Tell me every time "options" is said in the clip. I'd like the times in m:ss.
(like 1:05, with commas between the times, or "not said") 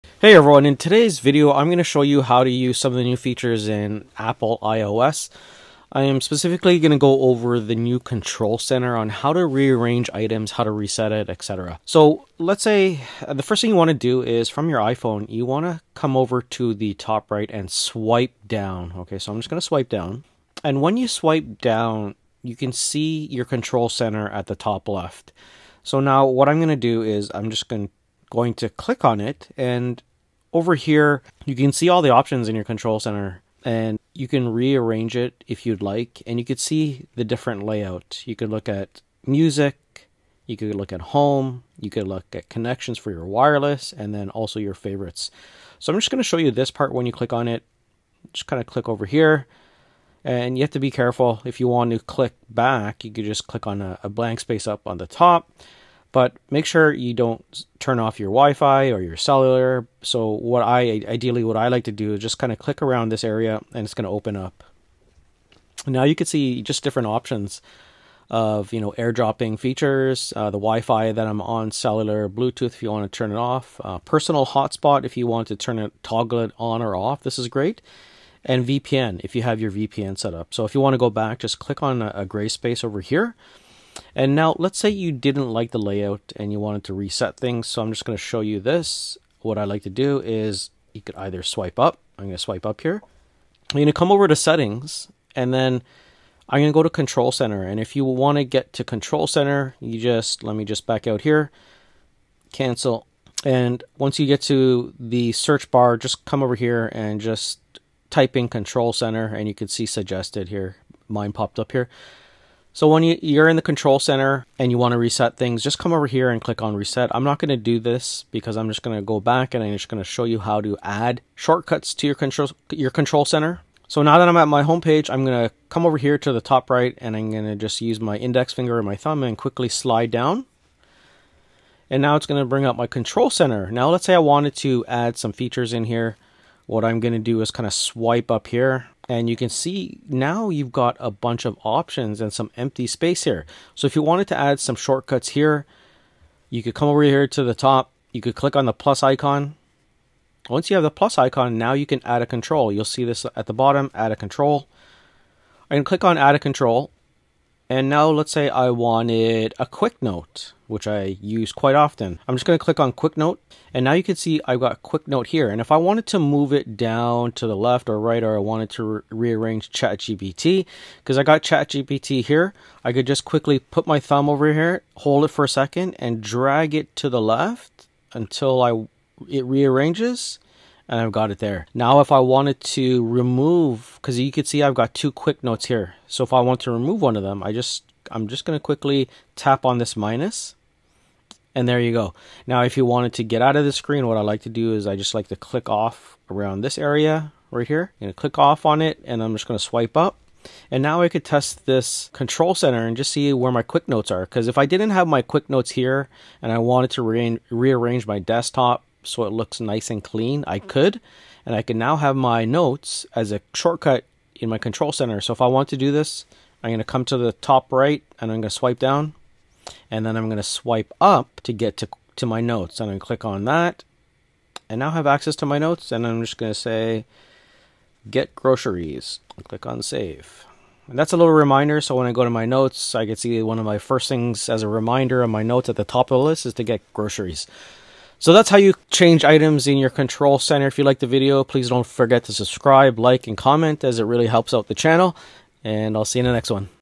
0:32, 1:07, 2:21.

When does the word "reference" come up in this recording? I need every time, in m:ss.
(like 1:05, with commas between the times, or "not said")
not said.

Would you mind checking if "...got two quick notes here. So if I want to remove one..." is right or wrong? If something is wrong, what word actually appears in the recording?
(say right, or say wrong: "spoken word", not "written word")
right.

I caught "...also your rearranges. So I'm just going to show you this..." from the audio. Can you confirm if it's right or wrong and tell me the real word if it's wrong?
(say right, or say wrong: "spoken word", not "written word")
wrong: "favorites", not "rearranges".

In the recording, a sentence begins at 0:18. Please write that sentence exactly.
Okay, so I'm just going to swipe down.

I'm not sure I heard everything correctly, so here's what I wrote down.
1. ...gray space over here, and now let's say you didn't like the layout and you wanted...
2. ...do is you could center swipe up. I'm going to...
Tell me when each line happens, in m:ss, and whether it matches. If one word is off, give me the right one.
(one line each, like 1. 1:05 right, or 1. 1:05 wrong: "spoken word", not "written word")
1. 1:22 right
2. 1:29 wrong: "either", not "center".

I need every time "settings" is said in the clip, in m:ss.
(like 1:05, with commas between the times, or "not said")
1:34.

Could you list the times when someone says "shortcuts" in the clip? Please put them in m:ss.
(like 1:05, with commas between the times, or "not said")
2:01, 2:24, 3:33.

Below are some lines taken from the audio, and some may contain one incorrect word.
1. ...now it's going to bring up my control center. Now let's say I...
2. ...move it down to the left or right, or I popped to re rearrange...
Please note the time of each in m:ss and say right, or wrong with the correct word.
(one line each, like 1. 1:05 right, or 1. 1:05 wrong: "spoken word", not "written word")
1. 2:12 right
2. 2:46 wrong: "wanted", not "popped".